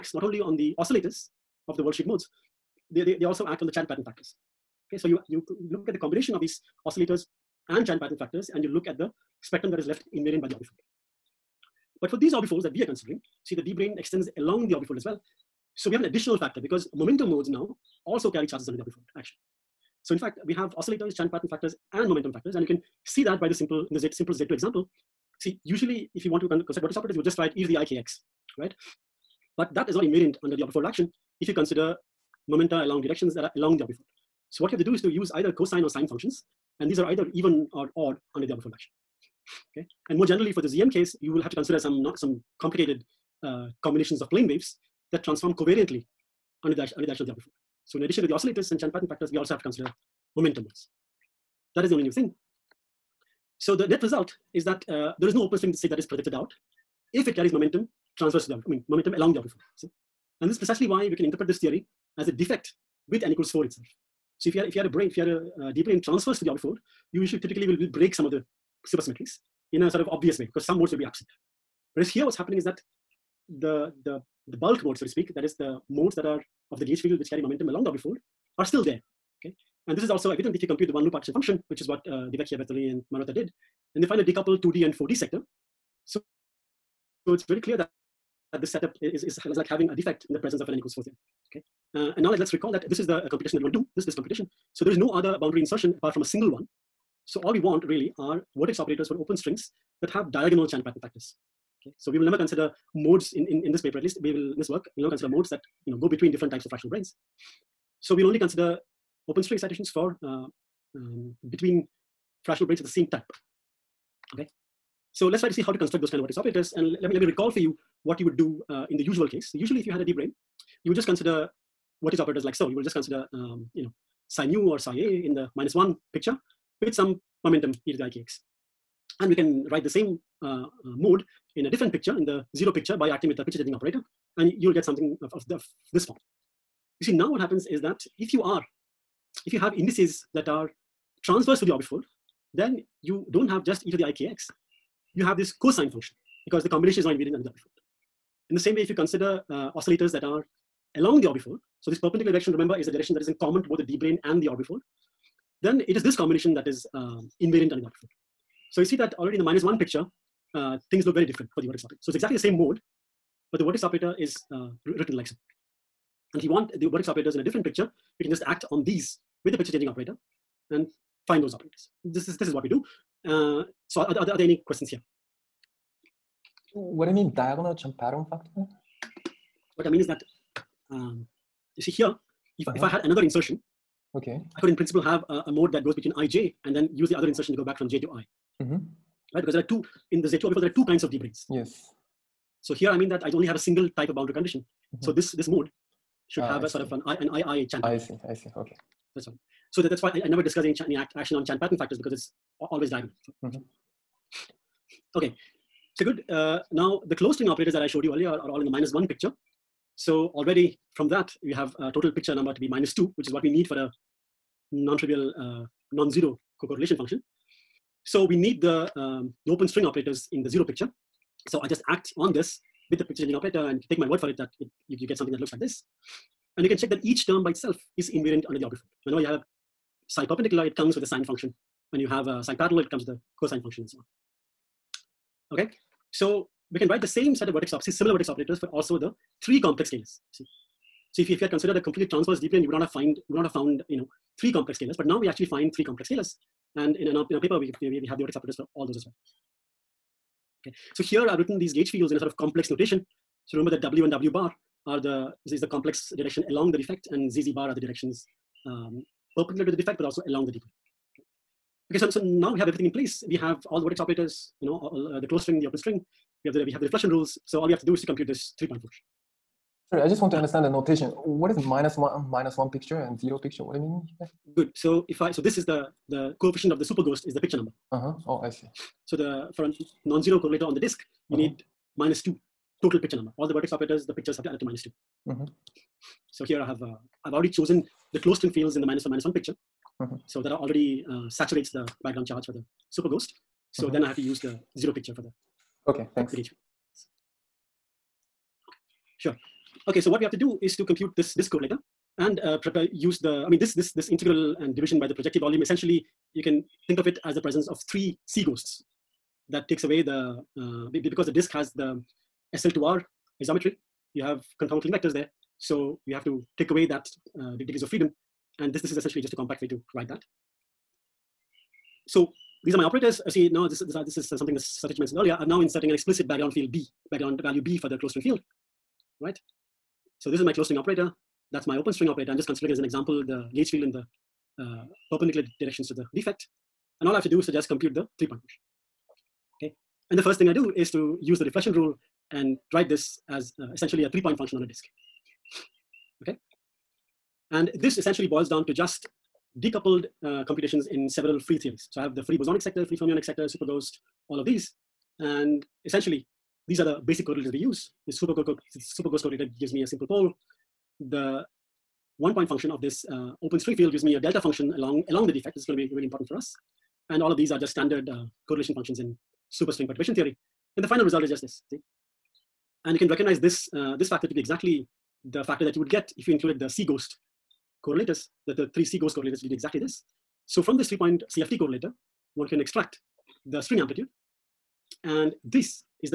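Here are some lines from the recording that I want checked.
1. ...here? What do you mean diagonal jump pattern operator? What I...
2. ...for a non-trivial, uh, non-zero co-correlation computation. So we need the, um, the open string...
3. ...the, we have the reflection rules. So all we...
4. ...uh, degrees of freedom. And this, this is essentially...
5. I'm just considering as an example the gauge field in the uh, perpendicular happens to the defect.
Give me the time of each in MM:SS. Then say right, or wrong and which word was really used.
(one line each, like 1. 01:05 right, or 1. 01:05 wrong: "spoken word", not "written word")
1. 02:54 wrong: "factor", not "operator"
2. 03:33 wrong: "function", not "computation"
3. 04:26 right
4. 05:17 right
5. 05:32 wrong: "directions", not "happens".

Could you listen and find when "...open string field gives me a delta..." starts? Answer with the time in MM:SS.
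06:03.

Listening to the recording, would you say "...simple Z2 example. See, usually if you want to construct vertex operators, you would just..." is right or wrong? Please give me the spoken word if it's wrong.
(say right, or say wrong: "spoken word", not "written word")
right.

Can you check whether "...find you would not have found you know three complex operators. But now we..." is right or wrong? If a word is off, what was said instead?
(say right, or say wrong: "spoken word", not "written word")
wrong: "scalars", not "operators".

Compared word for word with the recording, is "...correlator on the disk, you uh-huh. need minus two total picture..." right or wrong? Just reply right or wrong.
right.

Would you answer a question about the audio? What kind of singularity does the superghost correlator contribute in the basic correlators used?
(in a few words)
a simple pole.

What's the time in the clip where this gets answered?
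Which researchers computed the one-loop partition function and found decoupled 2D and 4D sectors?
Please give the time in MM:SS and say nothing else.
01:22.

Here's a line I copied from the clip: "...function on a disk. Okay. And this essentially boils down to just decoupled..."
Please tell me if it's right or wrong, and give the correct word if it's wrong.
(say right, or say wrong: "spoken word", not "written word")
right.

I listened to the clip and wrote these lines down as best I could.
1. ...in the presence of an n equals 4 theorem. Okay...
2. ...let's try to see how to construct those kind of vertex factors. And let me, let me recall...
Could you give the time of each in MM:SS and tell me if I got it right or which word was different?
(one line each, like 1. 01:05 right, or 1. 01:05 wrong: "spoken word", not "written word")
1. 01:30 right
2. 01:55 wrong: "operators", not "factors".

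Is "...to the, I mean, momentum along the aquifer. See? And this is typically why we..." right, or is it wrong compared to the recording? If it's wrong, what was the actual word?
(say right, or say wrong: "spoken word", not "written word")
wrong: "precisely", not "typically".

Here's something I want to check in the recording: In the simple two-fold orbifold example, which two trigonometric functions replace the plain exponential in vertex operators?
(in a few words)
cosine or sine.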